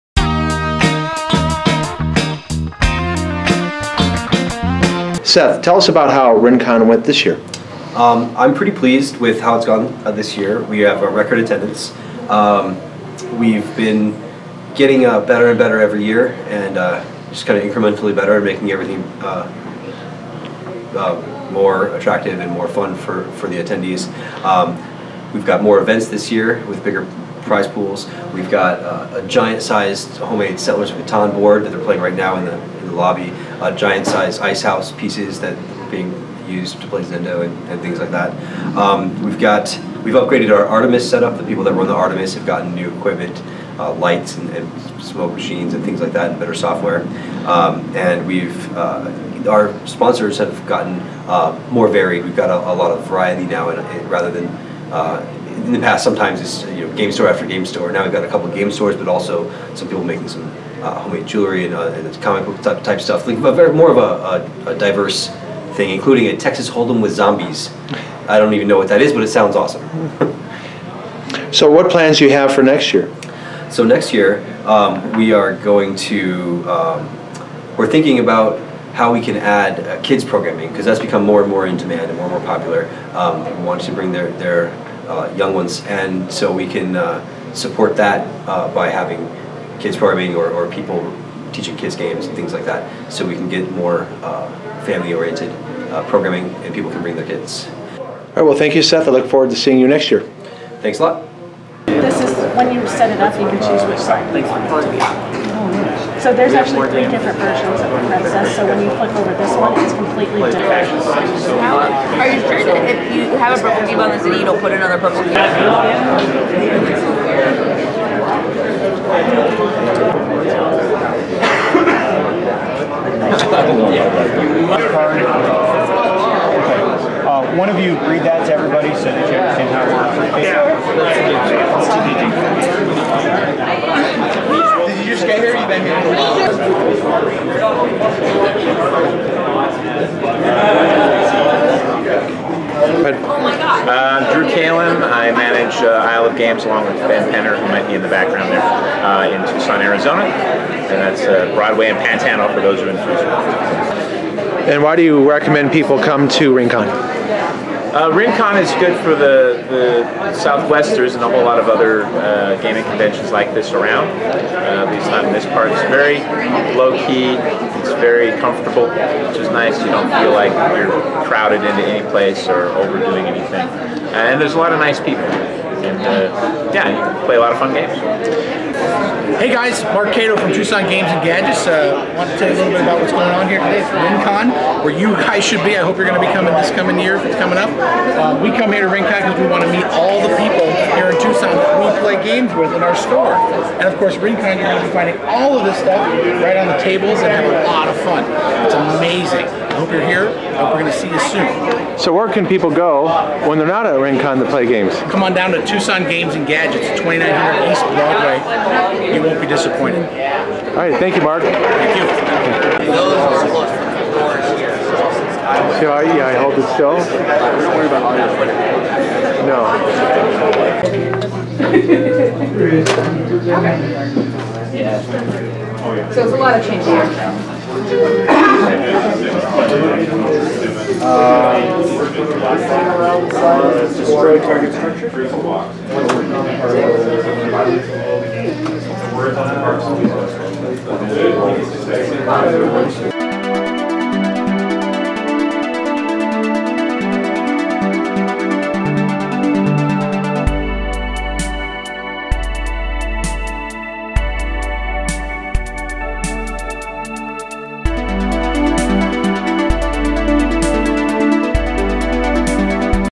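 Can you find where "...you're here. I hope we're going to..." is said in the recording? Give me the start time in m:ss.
3:19.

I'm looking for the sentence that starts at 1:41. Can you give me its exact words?
This is when you set it up, you can choose which side you want it to be on.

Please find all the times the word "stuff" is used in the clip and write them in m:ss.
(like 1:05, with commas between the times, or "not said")
1:03, 3:15.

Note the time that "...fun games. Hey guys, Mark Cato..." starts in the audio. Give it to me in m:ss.
2:57.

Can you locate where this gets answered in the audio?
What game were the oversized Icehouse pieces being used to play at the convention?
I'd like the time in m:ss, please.
0:37.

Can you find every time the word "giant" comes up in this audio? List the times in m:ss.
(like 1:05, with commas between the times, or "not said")
0:29, 0:33.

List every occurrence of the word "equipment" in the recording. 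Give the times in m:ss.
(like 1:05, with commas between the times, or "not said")
0:42.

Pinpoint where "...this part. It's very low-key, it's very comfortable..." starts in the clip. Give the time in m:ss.
2:45.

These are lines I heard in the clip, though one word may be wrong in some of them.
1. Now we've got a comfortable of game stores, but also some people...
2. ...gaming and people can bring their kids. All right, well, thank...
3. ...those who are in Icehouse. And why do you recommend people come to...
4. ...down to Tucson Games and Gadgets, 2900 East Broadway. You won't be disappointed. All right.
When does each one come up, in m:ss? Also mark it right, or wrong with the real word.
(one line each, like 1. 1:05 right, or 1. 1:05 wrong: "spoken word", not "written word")
1. 0:57 wrong: "couple", not "comfortable"
2. 1:36 wrong: "programming", not "gaming"
3. 2:32 wrong: "Tucson", not "Icehouse"
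4. 3:25 right.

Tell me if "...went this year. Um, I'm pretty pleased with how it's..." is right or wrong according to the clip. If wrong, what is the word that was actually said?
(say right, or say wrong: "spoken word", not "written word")
right.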